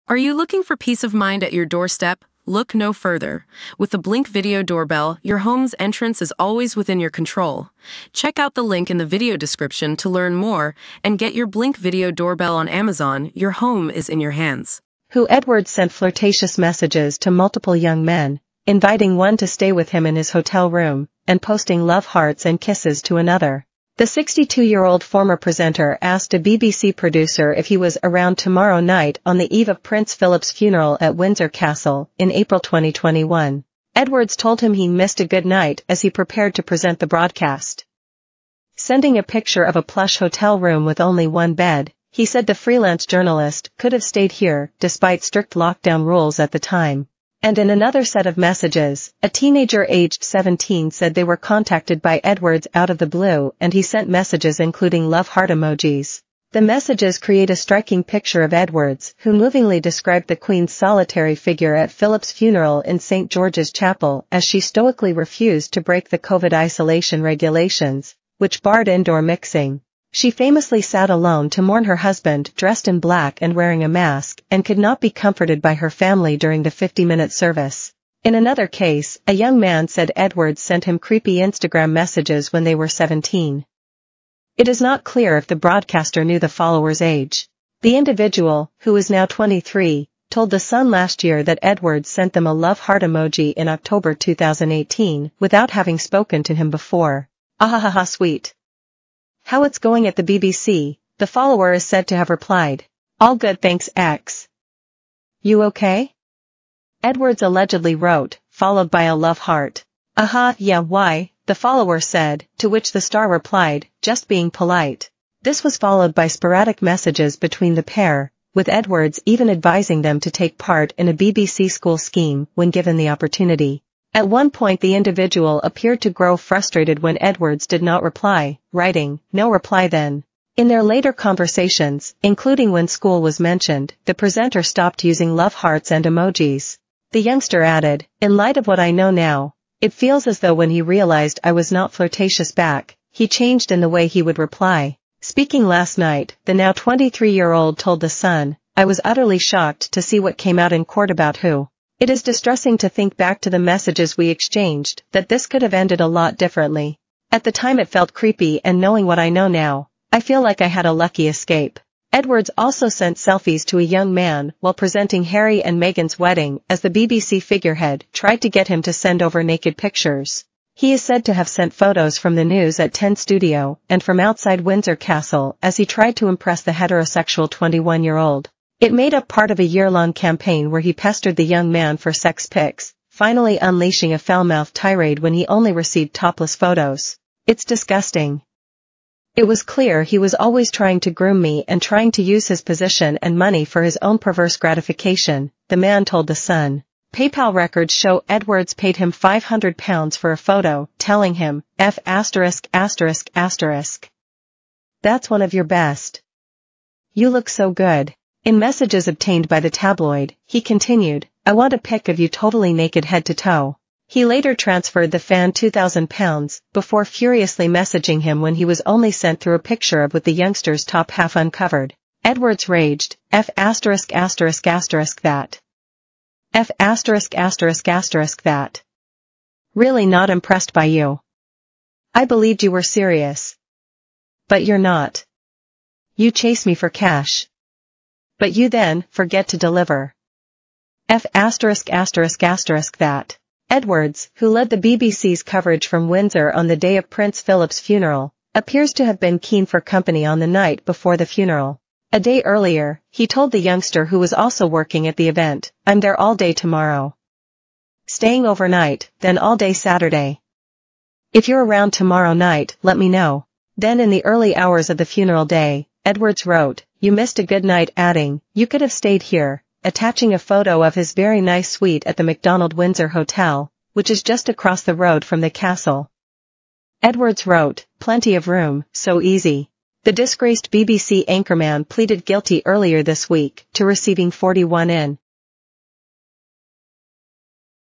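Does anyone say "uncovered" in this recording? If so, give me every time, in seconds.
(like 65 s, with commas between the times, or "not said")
221 s.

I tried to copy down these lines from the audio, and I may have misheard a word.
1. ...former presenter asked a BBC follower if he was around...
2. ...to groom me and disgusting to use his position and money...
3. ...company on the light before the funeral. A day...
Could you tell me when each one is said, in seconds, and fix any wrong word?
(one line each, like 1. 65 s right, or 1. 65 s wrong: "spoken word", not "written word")
1. 25 s wrong: "producer", not "follower"
2. 191 s wrong: "trying", not "disgusting"
3. 249 s wrong: "night", not "light".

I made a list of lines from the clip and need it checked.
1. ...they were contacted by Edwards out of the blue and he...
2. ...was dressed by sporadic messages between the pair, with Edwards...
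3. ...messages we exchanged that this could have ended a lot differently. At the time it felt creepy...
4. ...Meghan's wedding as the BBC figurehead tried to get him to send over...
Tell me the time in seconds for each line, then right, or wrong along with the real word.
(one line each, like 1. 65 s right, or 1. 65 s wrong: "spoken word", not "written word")
1. 51 s right
2. 115 s wrong: "followed", not "dressed"
3. 153 s right
4. 165 s right.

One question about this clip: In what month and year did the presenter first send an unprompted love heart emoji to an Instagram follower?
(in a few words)
October 2018.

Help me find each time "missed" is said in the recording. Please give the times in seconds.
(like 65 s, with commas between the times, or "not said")
34 s, 267 s.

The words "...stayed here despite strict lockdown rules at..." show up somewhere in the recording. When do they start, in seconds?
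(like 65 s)
44 s.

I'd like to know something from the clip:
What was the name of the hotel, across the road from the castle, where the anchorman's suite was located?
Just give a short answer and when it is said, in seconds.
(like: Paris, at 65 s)
Macdonald Windsor Hotel, at 272 s.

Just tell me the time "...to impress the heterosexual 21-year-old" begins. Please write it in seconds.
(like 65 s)
176 s.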